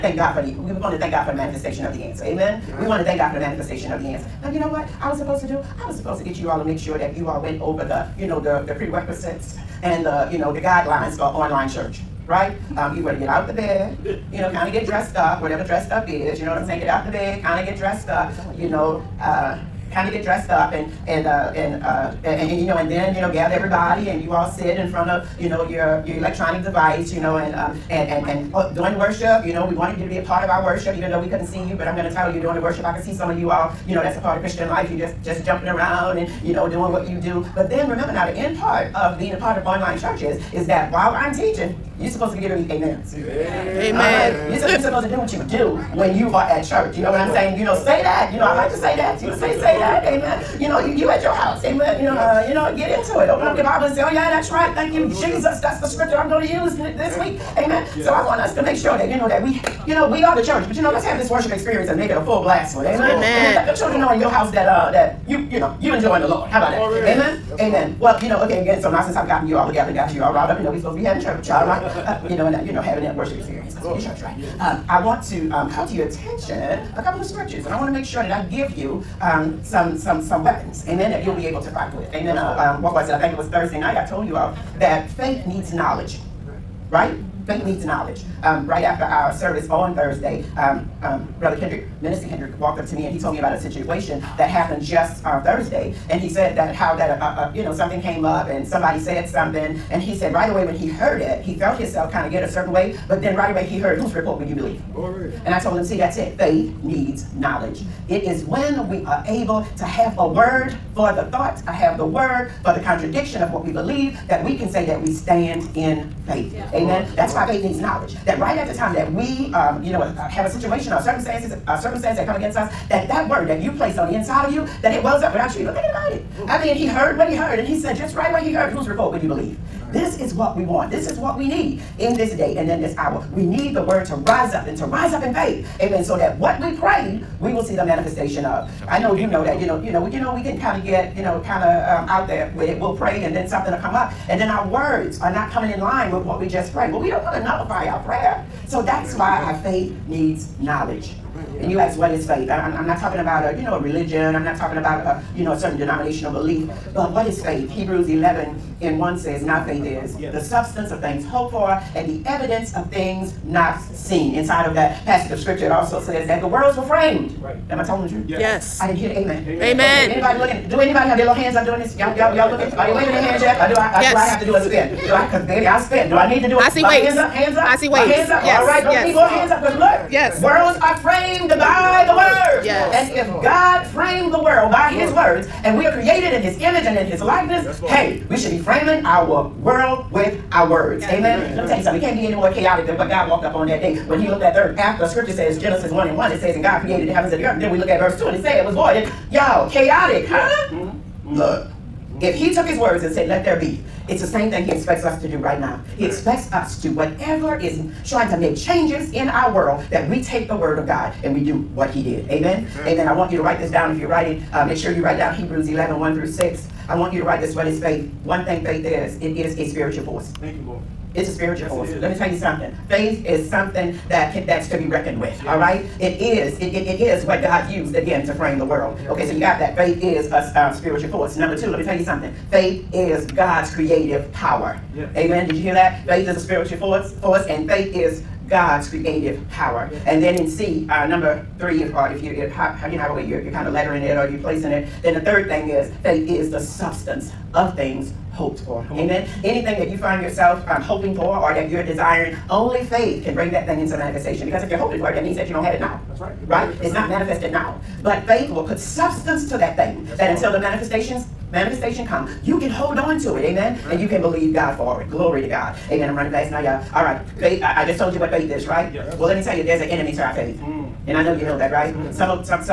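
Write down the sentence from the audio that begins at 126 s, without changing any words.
I mean, he heard what he heard, and he said just right what he heard.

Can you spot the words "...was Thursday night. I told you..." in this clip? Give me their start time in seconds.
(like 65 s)
83 s.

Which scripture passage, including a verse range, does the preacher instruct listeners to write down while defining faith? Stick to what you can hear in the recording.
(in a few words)
Hebrews 11:1-6.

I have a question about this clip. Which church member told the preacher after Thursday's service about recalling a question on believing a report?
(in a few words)
Minister Kendrick.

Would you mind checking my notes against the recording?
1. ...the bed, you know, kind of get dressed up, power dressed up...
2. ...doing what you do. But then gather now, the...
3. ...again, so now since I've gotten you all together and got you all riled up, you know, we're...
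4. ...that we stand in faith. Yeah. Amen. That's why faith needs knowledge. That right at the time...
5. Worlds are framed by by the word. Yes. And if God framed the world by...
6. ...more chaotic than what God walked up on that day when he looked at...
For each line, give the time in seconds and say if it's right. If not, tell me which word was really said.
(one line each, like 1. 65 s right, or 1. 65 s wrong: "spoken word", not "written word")
1. 13 s wrong: "whatever", not "power"
2. 36 s wrong: "remember", not "gather"
3. 68 s right
4. 114 s right
5. 180 s right
6. 192 s right.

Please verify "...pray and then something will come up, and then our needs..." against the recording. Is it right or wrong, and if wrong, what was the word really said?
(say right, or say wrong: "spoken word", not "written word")
wrong: "words", not "needs".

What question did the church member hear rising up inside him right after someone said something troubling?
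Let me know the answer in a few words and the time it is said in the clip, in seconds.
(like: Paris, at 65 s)
Whose report would you believe?, at 104 s.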